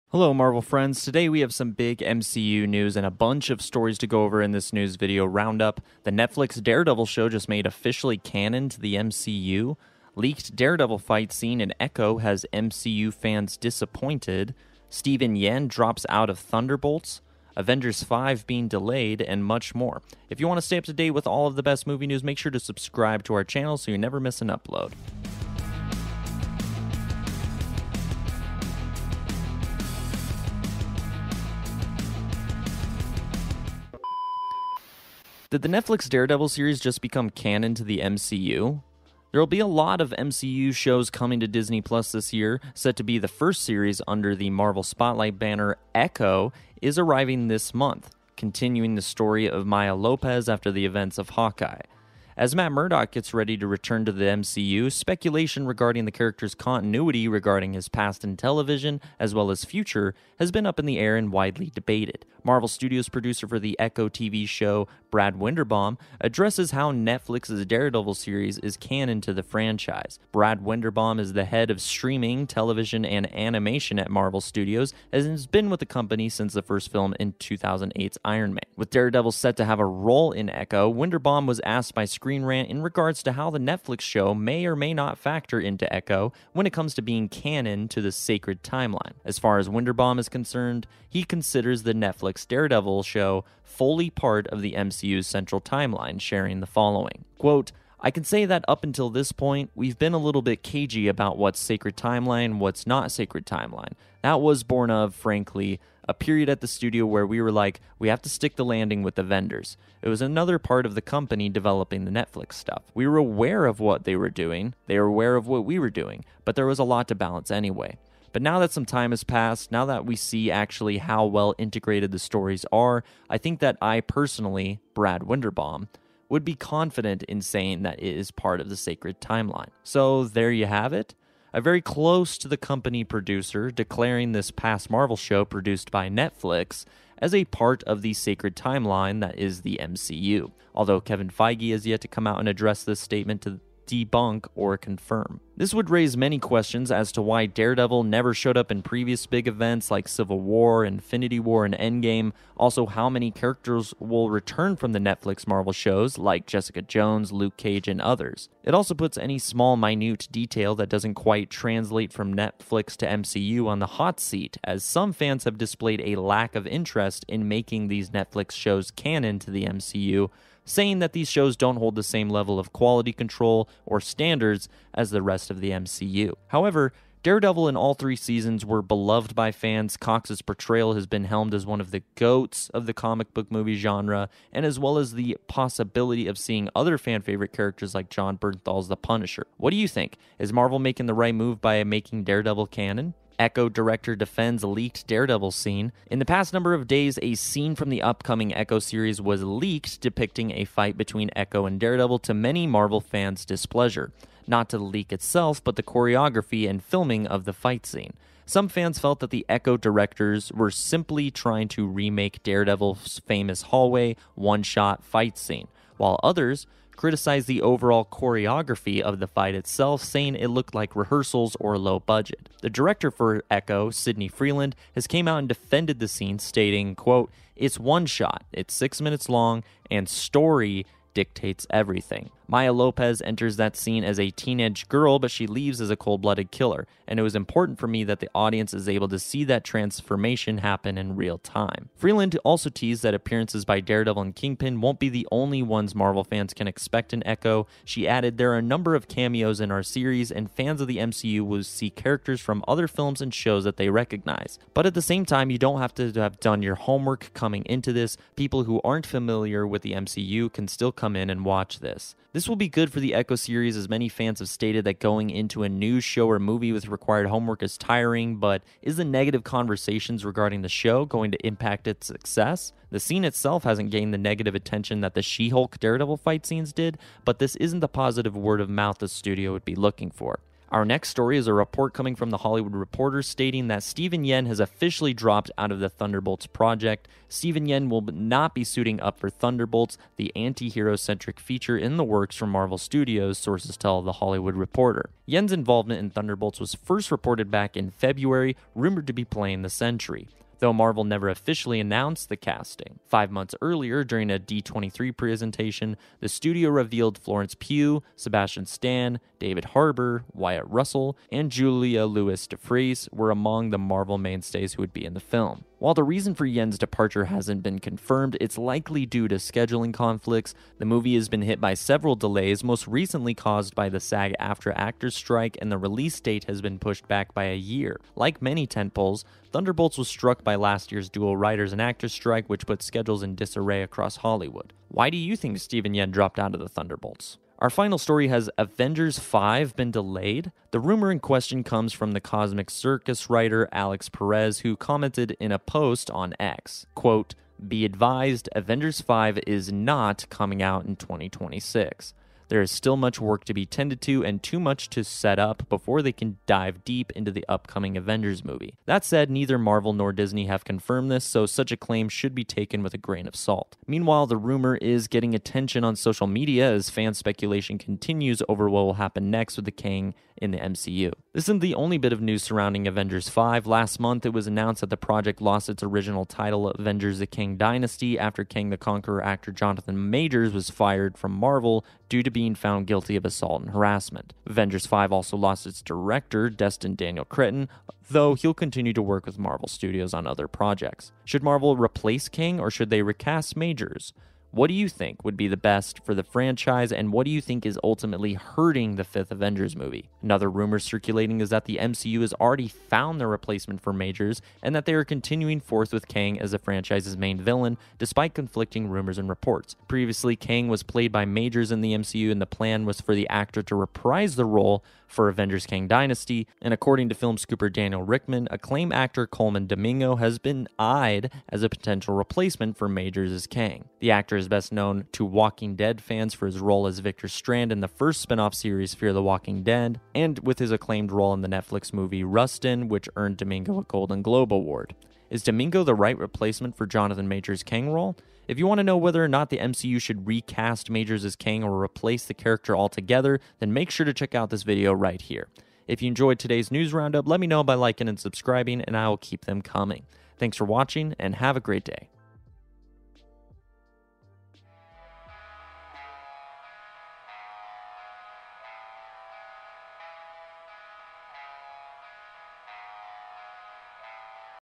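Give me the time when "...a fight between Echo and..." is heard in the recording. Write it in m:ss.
3:20.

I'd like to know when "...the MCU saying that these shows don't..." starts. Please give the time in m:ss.
2:49.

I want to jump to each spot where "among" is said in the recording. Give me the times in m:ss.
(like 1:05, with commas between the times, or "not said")
5:13.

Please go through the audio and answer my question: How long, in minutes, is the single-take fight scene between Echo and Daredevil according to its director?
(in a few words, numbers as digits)
6.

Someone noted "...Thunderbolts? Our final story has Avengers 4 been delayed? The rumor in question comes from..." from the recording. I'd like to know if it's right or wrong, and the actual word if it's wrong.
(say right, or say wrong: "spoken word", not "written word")
wrong: "5", not "4".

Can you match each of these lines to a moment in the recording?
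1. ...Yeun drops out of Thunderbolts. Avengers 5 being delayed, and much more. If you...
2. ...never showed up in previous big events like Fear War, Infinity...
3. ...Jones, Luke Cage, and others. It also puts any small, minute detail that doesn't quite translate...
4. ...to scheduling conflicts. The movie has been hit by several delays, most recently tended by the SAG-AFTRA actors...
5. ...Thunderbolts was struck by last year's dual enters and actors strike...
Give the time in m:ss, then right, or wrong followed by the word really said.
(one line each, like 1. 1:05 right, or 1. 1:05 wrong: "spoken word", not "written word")
1. 0:15 right
2. 2:28 wrong: "Civil", not "Fear"
3. 2:36 right
4. 5:19 wrong: "caused", not "tended"
5. 5:29 wrong: "writers", not "enters".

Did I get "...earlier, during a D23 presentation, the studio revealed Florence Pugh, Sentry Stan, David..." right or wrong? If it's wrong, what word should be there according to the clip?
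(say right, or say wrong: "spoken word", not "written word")
wrong: "Sebastian", not "Sentry".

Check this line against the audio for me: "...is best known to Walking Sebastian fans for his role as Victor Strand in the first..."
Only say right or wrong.
wrong.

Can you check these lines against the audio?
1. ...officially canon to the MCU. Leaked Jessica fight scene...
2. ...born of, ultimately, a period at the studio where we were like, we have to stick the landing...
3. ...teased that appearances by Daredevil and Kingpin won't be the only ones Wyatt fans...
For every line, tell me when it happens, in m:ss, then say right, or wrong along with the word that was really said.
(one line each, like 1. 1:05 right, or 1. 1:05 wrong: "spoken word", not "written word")
1. 0:07 wrong: "Daredevil", not "Jessica"
2. 1:44 wrong: "frankly", not "ultimately"
3. 4:02 wrong: "Marvel", not "Wyatt".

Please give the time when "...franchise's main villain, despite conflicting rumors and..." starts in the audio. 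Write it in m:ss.
6:46.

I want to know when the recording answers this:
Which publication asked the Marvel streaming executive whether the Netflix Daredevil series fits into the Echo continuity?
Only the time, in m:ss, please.
1:22.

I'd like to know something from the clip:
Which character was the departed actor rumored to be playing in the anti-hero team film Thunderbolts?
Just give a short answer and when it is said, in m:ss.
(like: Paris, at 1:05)
the Sentry, at 4:59.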